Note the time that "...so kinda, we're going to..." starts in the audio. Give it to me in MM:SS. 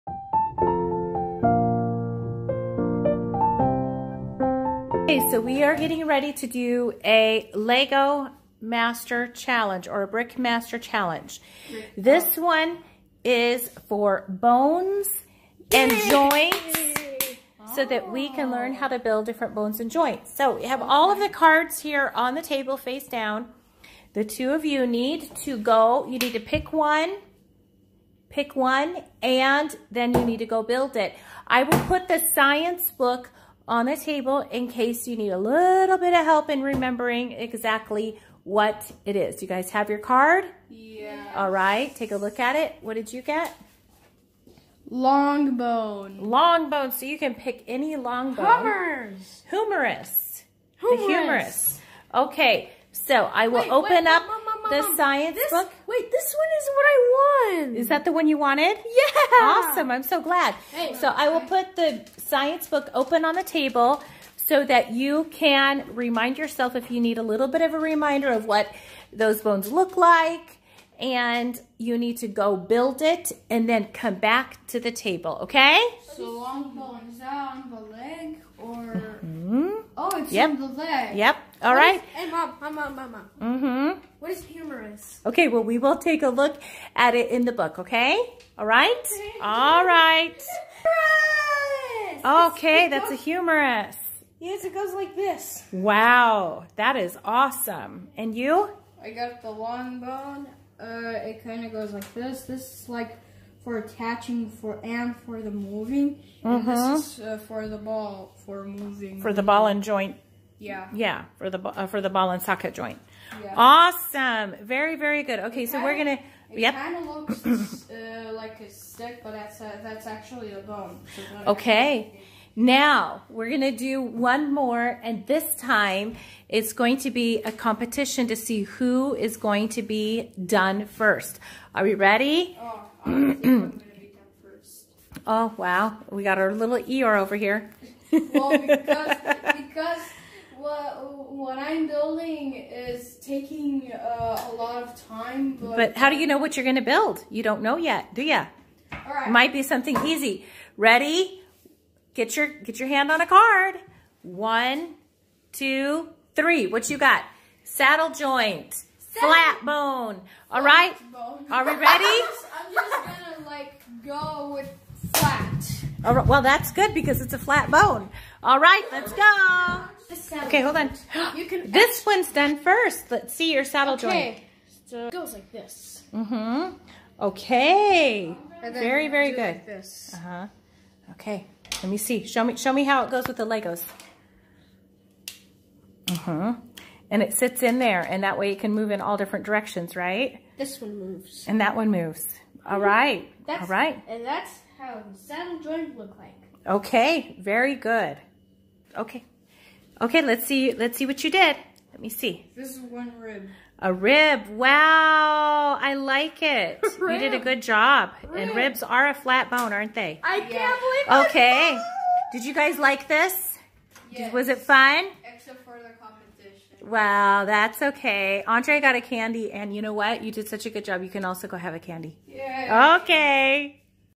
01:55.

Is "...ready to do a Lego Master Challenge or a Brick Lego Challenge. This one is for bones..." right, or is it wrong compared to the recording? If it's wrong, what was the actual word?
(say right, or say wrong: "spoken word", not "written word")
wrong: "Master", not "Lego".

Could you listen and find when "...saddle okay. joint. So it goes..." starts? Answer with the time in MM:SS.
02:53.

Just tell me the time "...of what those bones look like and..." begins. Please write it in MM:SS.
01:08.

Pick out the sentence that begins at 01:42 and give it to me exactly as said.
This is like for attaching for and for the moving.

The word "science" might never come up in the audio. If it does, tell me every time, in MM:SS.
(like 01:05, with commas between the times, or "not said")
00:32, 00:54, 01:02.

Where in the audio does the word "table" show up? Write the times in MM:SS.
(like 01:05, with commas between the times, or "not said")
00:22, 00:33, 01:03, 01:14.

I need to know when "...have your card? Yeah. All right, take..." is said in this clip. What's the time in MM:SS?
00:39.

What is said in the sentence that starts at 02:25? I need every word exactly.
But, but how do you know what you're going to build?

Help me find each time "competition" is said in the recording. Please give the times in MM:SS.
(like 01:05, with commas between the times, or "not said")
02:07, 03:36.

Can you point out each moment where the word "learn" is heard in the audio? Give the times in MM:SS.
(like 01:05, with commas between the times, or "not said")
00:18.